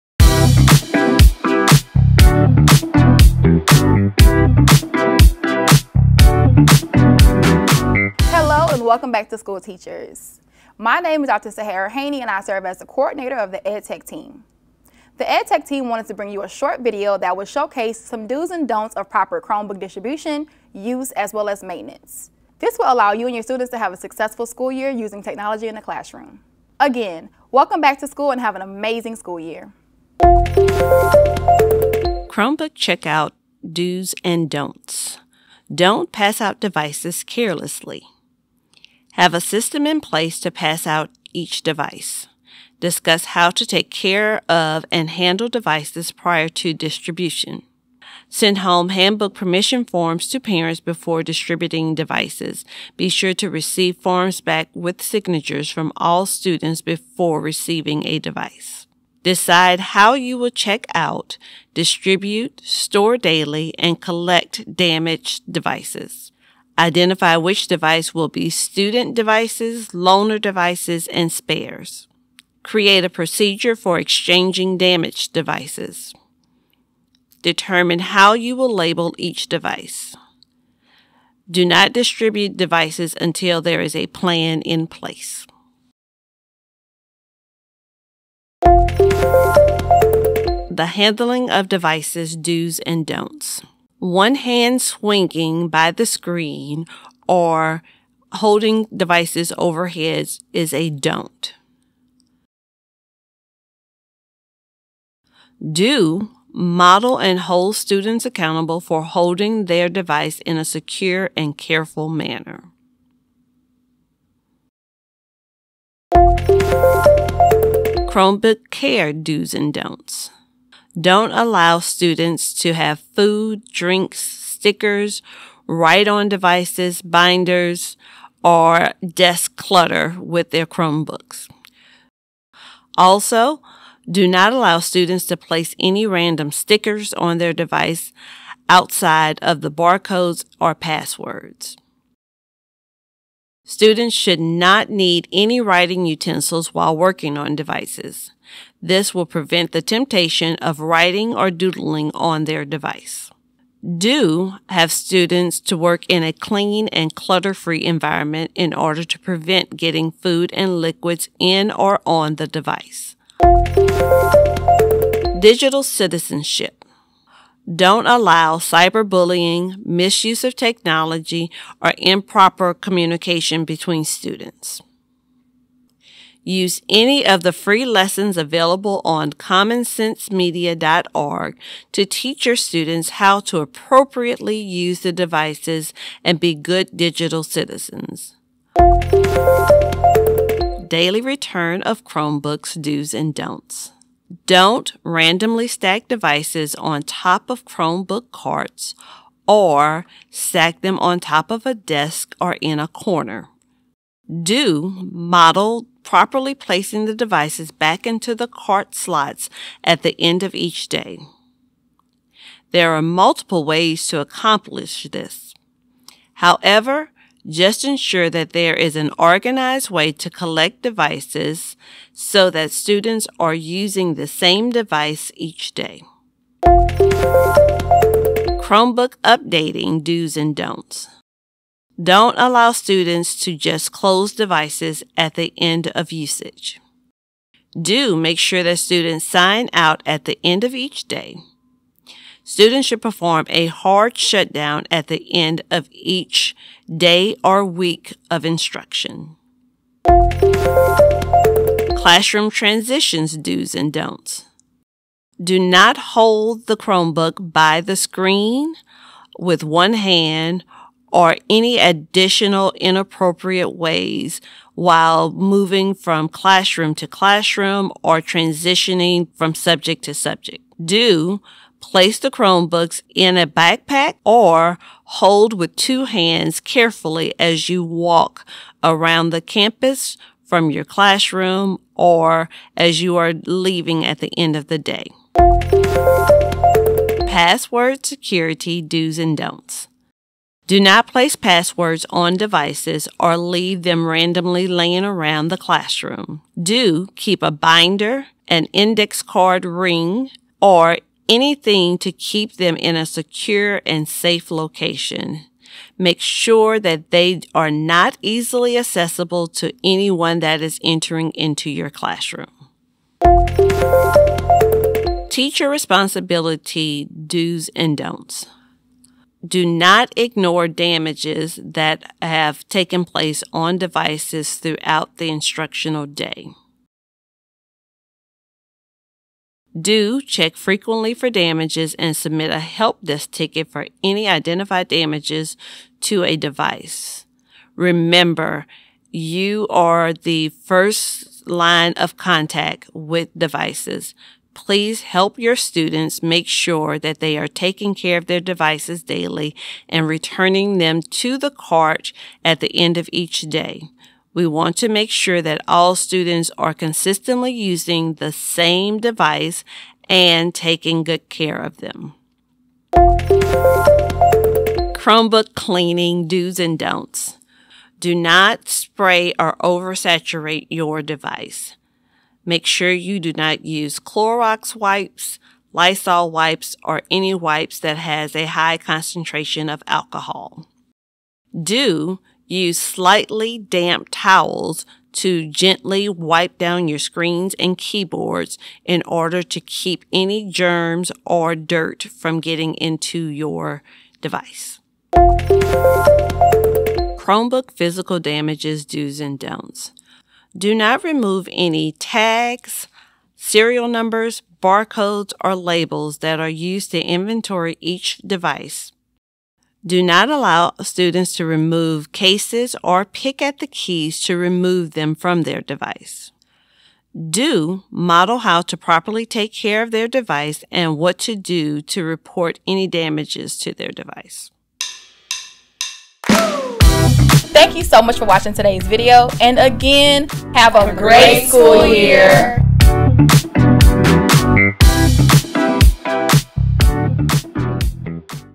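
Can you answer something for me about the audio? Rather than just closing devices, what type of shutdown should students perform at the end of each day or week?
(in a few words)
hard shutdown.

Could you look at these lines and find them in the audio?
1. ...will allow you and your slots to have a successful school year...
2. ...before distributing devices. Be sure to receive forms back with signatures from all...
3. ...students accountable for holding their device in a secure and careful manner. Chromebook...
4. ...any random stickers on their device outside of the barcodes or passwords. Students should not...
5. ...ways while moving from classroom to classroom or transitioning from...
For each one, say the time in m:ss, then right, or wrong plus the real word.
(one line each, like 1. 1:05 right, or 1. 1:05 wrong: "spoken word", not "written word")
1. 0:22 wrong: "students", not "slots"
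2. 0:50 right
3. 1:47 right
4. 2:15 right
5. 4:23 right.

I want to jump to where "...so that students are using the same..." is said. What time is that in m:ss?
3:42.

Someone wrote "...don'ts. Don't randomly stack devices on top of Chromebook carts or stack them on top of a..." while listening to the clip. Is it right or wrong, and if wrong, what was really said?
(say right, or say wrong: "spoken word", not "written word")
right.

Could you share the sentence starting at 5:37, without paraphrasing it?
Remember, you are the first line of contact with devices.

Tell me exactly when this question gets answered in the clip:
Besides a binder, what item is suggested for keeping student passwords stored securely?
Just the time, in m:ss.
4:58.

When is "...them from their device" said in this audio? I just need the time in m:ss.
6:54.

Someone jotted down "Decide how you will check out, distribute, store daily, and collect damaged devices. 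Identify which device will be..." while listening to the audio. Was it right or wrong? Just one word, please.
right.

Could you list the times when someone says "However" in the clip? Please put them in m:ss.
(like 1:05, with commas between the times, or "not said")
3:36.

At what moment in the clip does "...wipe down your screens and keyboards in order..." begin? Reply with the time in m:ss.
6:26.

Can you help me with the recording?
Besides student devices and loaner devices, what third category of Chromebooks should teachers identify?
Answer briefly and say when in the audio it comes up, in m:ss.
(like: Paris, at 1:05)
spares, at 1:11.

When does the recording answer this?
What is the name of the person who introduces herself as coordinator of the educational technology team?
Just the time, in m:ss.
0:11.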